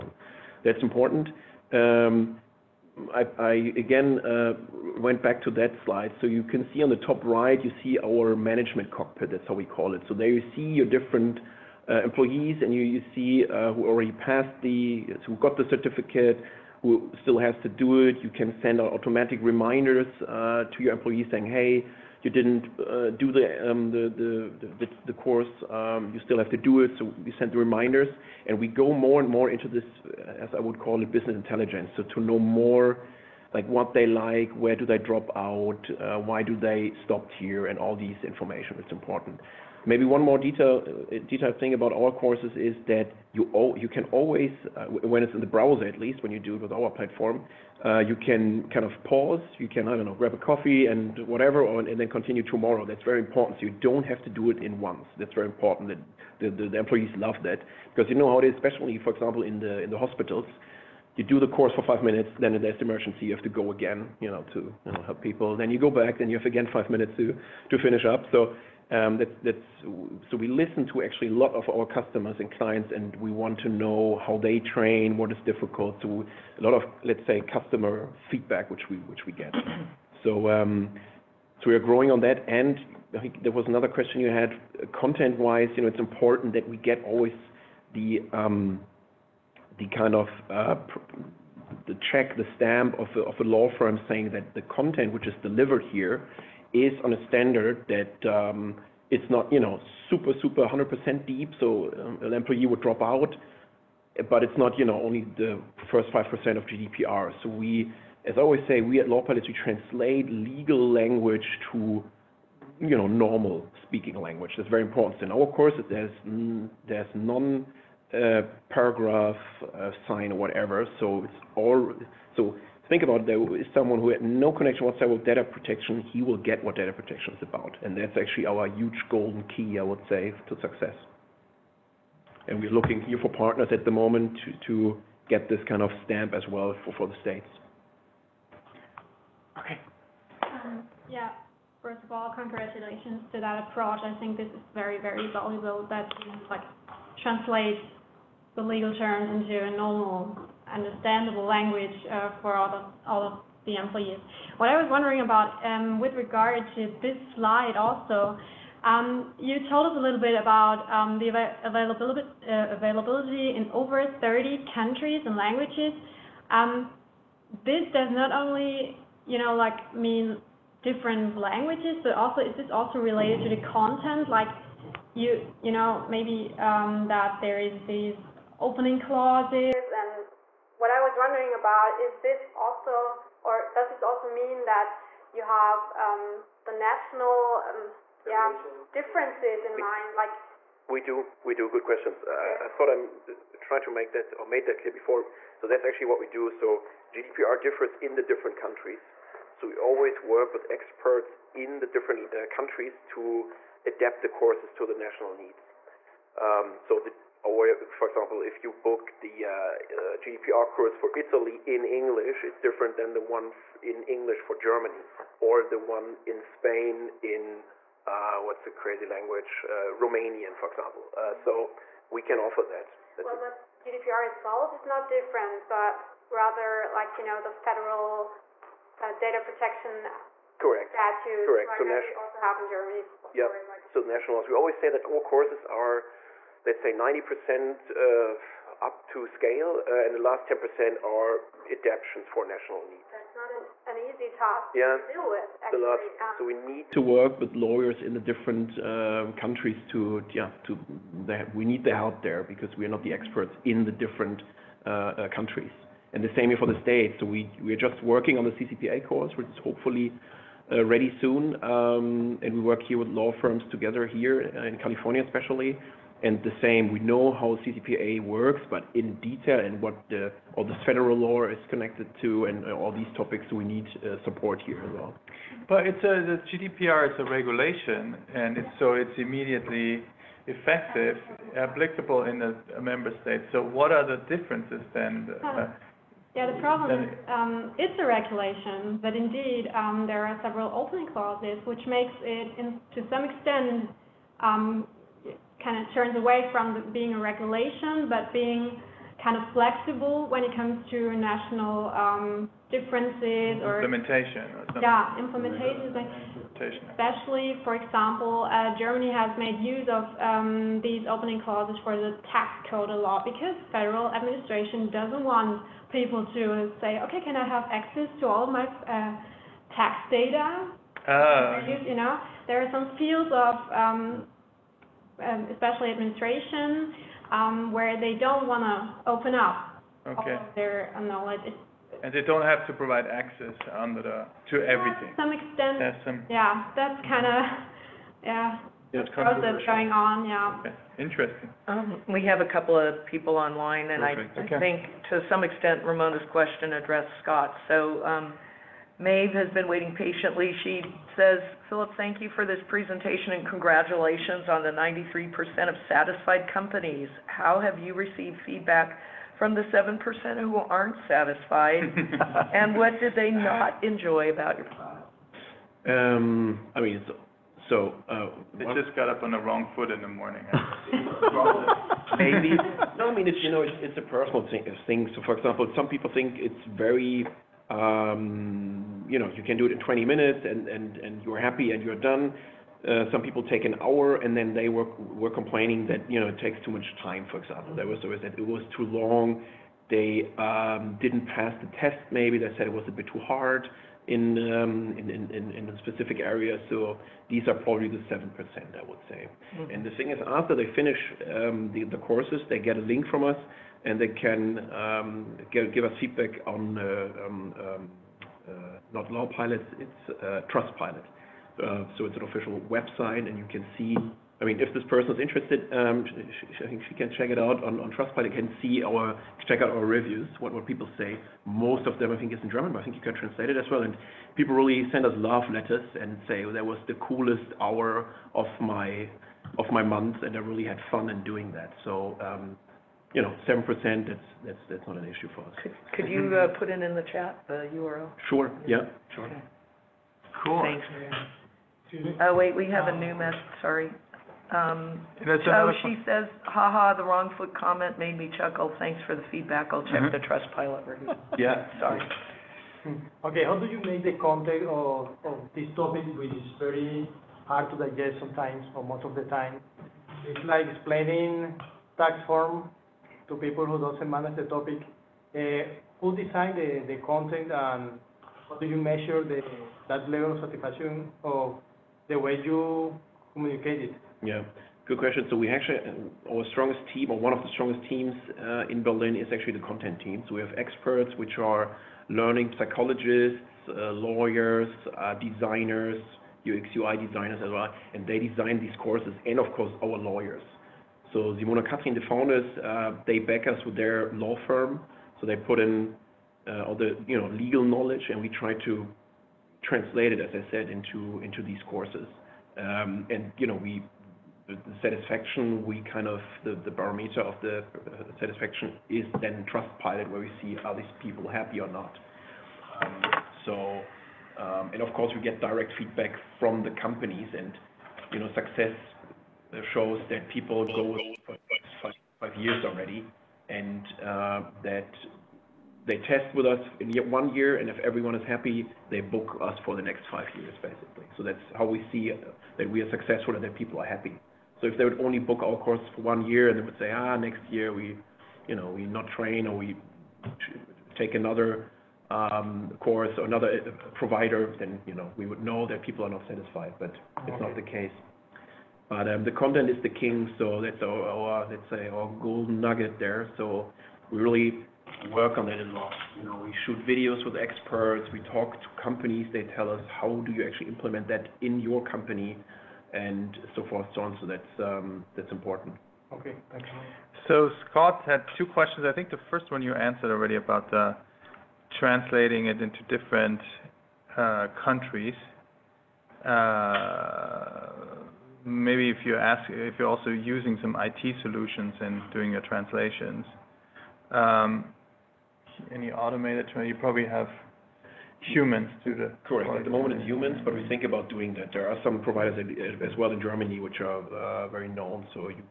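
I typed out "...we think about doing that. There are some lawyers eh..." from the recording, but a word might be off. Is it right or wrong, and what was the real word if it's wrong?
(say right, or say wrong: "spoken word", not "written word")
wrong: "providers", not "lawyers".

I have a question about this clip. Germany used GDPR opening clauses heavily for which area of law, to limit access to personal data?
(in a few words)
tax code.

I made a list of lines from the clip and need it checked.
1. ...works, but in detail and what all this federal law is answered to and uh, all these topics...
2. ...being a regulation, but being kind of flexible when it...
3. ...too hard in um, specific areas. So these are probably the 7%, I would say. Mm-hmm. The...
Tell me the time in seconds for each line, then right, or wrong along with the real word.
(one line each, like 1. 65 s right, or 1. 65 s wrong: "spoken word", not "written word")
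1. 268 s wrong: "connected", not "answered"
2. 296 s right
3. 393 s right.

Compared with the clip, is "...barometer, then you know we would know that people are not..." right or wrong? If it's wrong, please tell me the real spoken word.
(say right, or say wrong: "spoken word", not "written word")
wrong: "provider", not "barometer".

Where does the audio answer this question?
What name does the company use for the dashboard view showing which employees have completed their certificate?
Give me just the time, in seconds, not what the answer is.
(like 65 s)
8 s.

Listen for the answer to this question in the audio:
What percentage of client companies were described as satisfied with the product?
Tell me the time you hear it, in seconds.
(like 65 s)
354 s.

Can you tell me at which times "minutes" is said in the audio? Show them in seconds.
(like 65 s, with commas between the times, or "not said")
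62 s, 66 s, 380 s.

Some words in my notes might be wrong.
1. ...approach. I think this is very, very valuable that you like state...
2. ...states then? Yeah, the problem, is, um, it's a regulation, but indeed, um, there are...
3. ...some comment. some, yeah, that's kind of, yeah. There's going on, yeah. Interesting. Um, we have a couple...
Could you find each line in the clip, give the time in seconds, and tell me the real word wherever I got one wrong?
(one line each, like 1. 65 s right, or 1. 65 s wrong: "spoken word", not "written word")
1. 143 s wrong: "translate", not "state"
2. 284 s wrong: "differences", not "states"
3. 335 s wrong: "extent", not "comment".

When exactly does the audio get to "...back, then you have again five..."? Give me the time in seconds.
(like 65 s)
65 s.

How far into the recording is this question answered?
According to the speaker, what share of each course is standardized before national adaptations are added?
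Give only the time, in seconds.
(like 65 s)
236 s.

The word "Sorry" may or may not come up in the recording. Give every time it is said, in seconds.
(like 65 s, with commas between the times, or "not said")
443 s, 451 s.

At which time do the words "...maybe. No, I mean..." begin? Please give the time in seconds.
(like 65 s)
372 s.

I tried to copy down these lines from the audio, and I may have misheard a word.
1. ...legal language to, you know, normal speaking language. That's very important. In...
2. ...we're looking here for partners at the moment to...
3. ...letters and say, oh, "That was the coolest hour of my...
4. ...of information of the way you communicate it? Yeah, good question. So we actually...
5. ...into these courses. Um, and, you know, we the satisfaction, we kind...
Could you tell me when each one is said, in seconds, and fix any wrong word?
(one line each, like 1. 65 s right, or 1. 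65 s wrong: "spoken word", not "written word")
1. 110 s right
2. 132 s right
3. 425 s right
4. 470 s wrong: "satisfaction", not "information"
5. 500 s right.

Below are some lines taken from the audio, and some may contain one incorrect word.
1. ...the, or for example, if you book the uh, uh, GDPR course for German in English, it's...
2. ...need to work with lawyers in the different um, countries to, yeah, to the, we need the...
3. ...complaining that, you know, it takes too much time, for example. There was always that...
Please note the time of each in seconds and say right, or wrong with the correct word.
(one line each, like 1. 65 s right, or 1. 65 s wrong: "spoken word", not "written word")
1. 206 s wrong: "Italy", not "German"
2. 246 s right
3. 385 s right.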